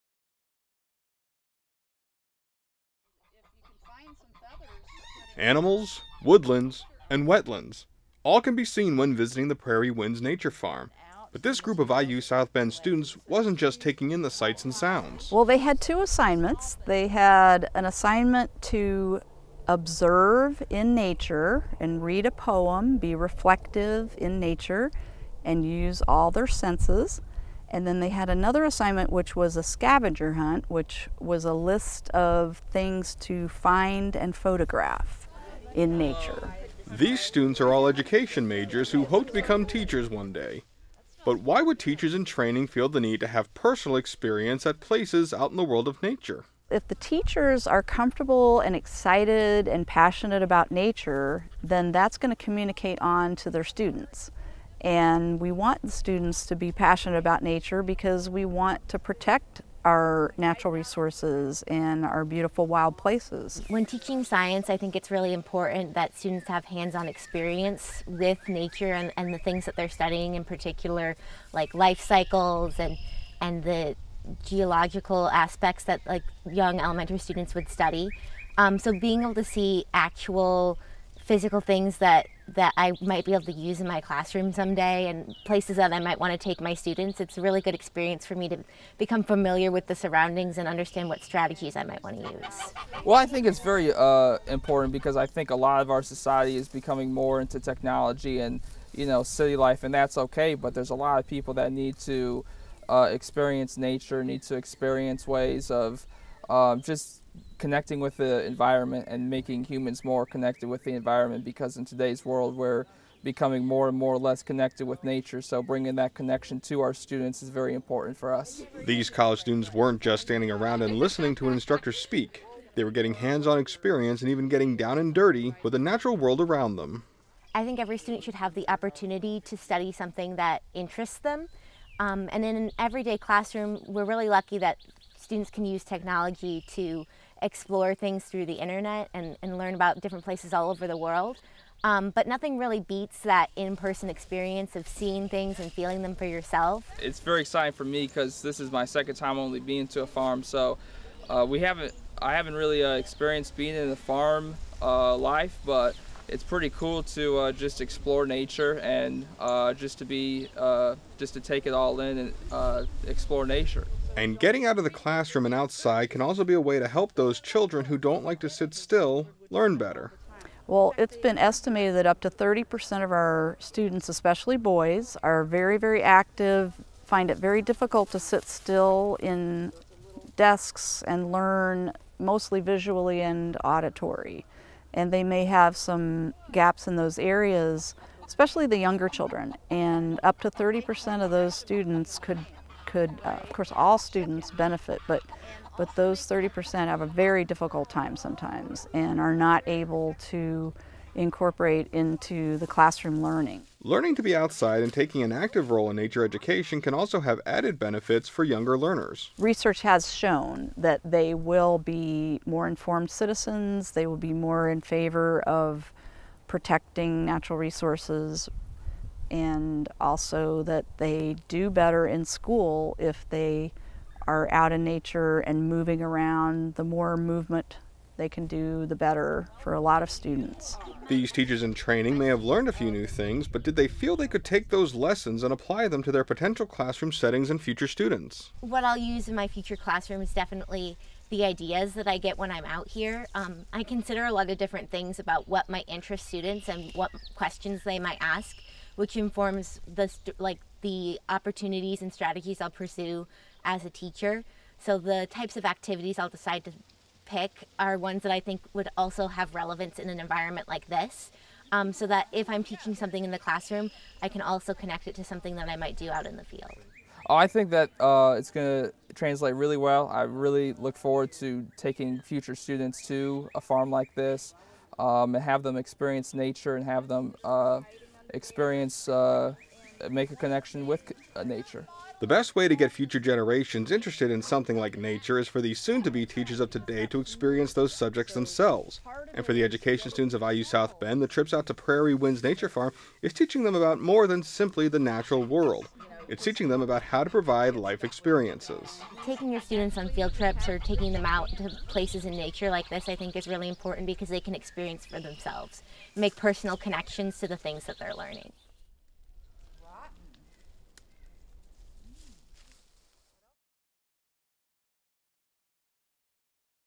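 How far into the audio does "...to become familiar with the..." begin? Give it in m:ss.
1:28.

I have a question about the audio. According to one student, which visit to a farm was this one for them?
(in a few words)
Second.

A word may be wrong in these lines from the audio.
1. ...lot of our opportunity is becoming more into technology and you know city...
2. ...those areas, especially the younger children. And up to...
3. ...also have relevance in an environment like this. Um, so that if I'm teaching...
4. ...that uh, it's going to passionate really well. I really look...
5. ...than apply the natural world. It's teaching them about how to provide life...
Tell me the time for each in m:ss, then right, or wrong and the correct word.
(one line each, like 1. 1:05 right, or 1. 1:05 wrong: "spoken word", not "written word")
1. 1:35 wrong: "society", not "opportunity"
2. 3:06 right
3. 4:18 right
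4. 4:27 wrong: "translate", not "passionate"
5. 4:54 wrong: "simply", not "apply".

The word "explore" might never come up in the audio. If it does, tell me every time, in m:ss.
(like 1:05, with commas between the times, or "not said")
2:17, 2:37, 2:43.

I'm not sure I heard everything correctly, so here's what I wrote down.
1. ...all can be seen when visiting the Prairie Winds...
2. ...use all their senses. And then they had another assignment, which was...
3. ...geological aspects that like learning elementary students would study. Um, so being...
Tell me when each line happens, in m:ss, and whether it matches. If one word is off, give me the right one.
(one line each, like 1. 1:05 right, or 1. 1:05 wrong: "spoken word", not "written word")
1. 0:08 right
2. 0:25 right
3. 1:14 wrong: "young", not "learning".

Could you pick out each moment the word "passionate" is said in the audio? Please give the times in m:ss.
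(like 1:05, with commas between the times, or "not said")
0:49, 0:56.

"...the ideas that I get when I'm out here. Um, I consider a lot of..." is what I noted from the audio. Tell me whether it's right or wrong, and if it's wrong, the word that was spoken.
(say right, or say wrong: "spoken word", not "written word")
right.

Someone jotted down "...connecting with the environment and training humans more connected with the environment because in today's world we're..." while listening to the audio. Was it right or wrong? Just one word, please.
wrong.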